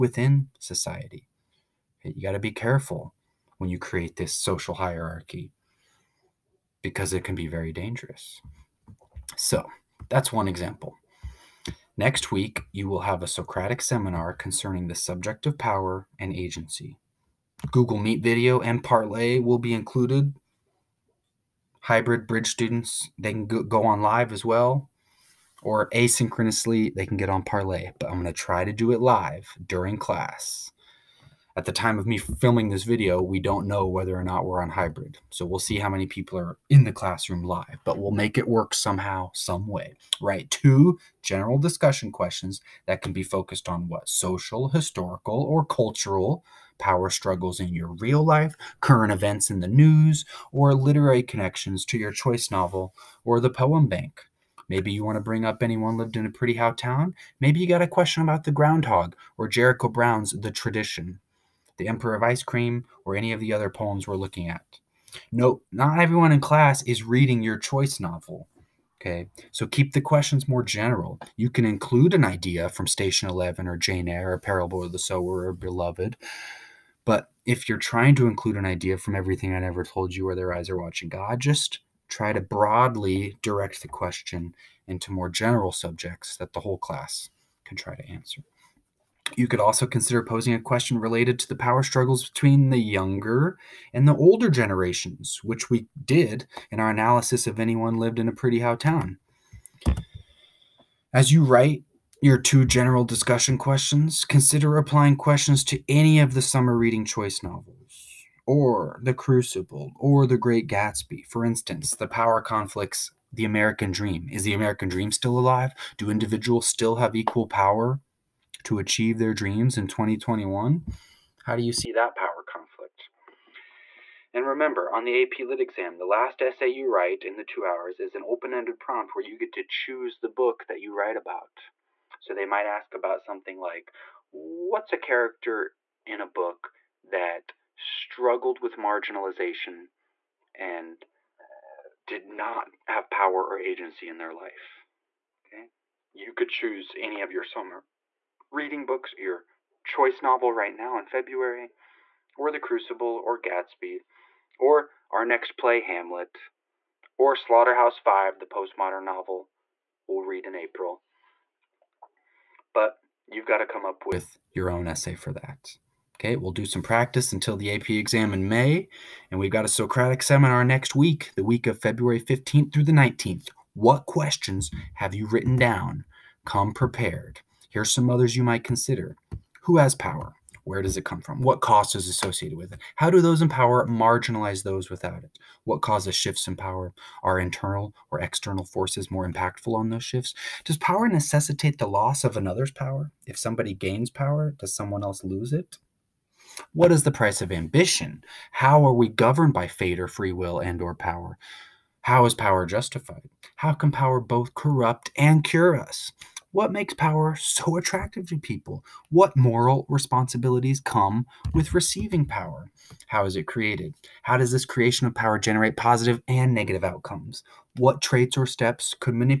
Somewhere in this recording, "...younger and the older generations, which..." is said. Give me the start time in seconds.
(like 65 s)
92 s.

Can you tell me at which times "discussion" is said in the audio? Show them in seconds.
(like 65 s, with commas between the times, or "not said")
41 s, 103 s.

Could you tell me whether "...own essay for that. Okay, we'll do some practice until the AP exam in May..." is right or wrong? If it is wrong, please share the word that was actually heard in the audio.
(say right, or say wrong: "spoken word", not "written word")
right.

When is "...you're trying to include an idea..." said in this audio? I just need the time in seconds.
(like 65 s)
77 s.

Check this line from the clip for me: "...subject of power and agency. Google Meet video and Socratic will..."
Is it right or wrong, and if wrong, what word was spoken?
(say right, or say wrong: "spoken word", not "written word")
wrong: "Parlay", not "Socratic".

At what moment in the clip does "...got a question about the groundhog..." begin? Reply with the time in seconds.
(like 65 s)
57 s.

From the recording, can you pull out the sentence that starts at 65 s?
No, not everyone in class is reading your choice novel.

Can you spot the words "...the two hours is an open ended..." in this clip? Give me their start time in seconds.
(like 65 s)
127 s.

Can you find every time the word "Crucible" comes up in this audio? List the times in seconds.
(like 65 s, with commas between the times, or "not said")
109 s, 152 s.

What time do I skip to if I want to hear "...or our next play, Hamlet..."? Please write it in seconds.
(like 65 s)
154 s.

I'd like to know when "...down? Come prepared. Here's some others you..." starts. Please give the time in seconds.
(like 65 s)
175 s.